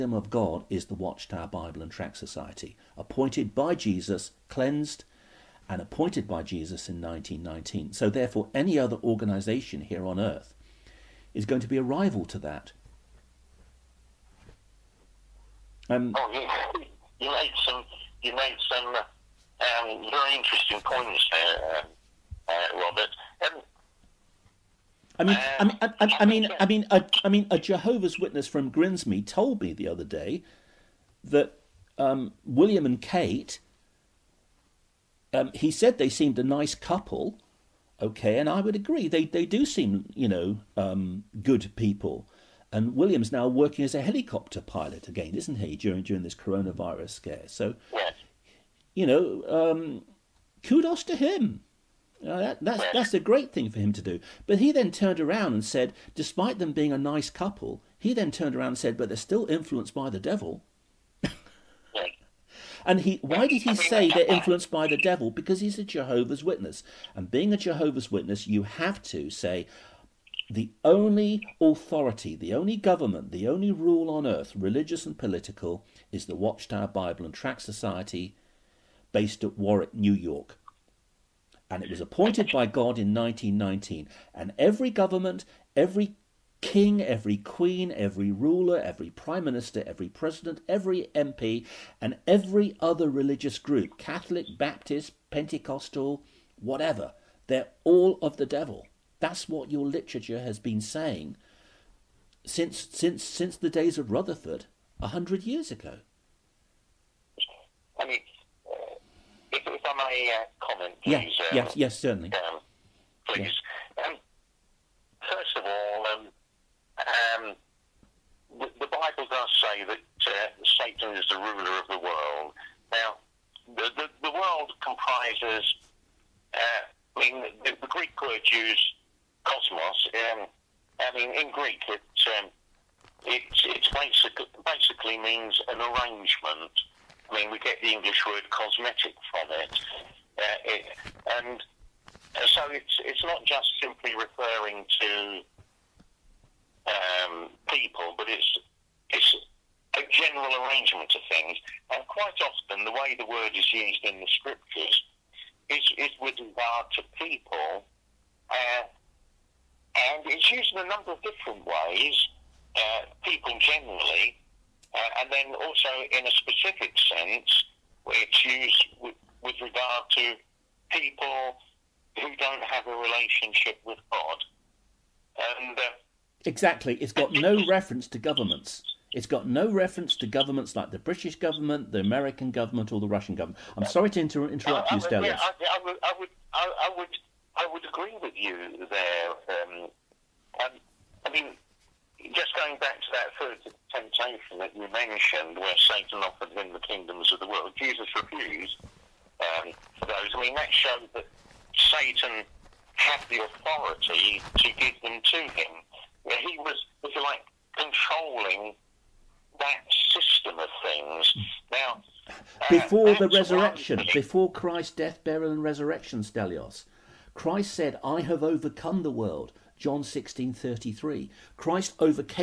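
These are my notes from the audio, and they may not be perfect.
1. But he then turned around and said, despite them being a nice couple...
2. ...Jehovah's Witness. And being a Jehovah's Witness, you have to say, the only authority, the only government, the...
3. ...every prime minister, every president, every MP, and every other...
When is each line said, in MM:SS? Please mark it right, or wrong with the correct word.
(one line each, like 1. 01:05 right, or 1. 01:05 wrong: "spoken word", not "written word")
1. 00:54 right
2. 01:05 right
3. 01:28 right.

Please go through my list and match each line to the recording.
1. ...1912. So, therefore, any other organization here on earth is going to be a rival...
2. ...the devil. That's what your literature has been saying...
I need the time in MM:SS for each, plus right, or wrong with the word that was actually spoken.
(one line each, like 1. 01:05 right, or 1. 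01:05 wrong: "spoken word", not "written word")
1. 00:07 wrong: "1919", not "1912"
2. 01:38 right.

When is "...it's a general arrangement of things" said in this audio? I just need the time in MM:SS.
02:29.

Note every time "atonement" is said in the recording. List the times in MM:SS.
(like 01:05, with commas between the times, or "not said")
not said.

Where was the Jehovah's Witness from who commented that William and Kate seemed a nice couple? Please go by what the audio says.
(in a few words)
Grimsby.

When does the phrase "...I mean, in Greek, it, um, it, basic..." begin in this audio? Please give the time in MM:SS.
02:11.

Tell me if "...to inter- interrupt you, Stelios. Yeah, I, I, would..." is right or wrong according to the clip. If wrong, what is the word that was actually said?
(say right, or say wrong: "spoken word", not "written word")
right.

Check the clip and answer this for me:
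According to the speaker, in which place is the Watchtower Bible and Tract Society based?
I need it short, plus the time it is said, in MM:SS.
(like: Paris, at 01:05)
Warwick, New York, at 01:19.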